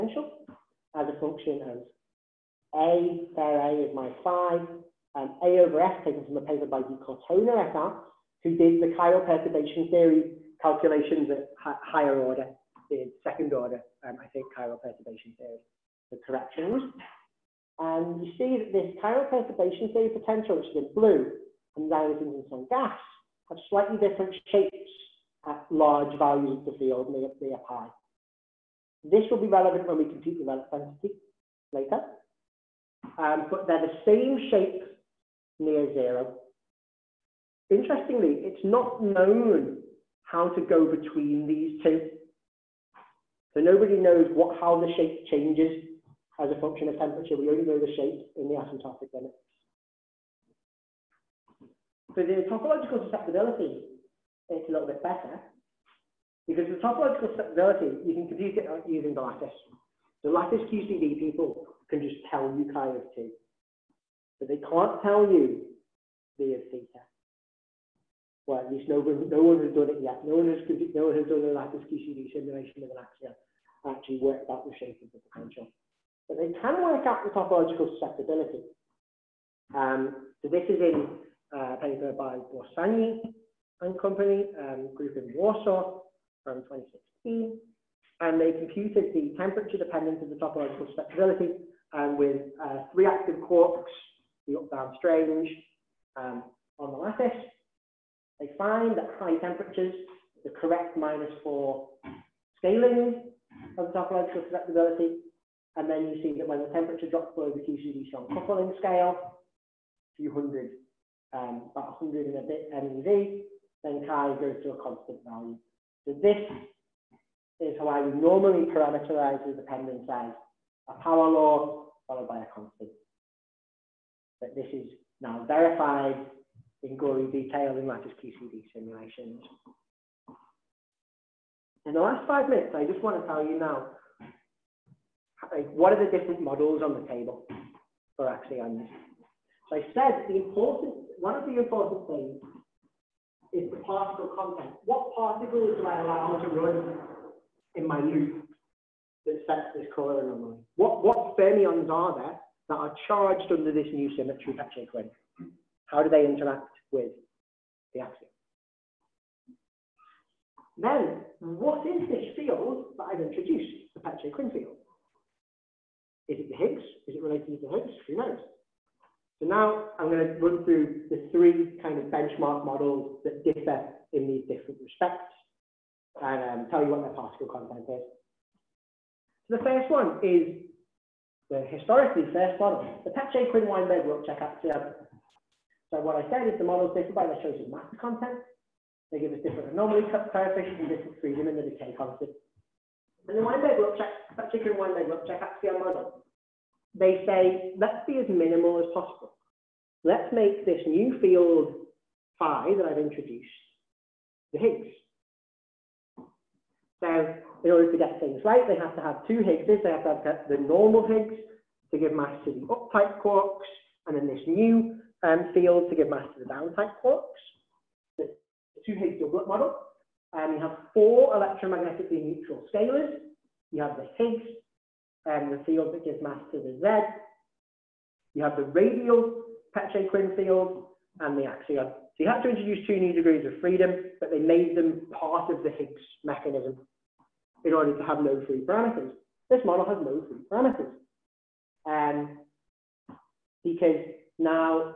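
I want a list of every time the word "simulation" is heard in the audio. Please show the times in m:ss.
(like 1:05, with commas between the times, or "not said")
1:12, 2:08.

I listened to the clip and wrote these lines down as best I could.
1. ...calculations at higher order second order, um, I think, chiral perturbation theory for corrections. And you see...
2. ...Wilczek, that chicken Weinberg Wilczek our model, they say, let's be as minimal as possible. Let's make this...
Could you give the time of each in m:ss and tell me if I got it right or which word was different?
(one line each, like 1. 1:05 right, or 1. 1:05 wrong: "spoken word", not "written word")
1. 0:10 right
2. 3:13 right.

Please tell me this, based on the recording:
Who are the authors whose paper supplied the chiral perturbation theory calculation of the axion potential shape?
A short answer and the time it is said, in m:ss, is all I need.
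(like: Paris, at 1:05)
di Cortona et al., at 0:06.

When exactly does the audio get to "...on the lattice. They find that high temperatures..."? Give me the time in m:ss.
1:36.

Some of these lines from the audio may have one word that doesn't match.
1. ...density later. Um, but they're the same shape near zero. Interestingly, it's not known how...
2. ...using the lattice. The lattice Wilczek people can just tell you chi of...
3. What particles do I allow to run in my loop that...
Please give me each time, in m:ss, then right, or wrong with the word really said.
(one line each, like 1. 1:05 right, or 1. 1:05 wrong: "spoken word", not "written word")
1. 0:30 right
2. 0:58 wrong: "QCD", not "Wilczek"
3. 2:24 right.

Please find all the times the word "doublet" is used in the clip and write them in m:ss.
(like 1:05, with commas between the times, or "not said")
3:39.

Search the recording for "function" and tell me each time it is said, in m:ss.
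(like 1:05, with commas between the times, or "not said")
0:01, 0:46.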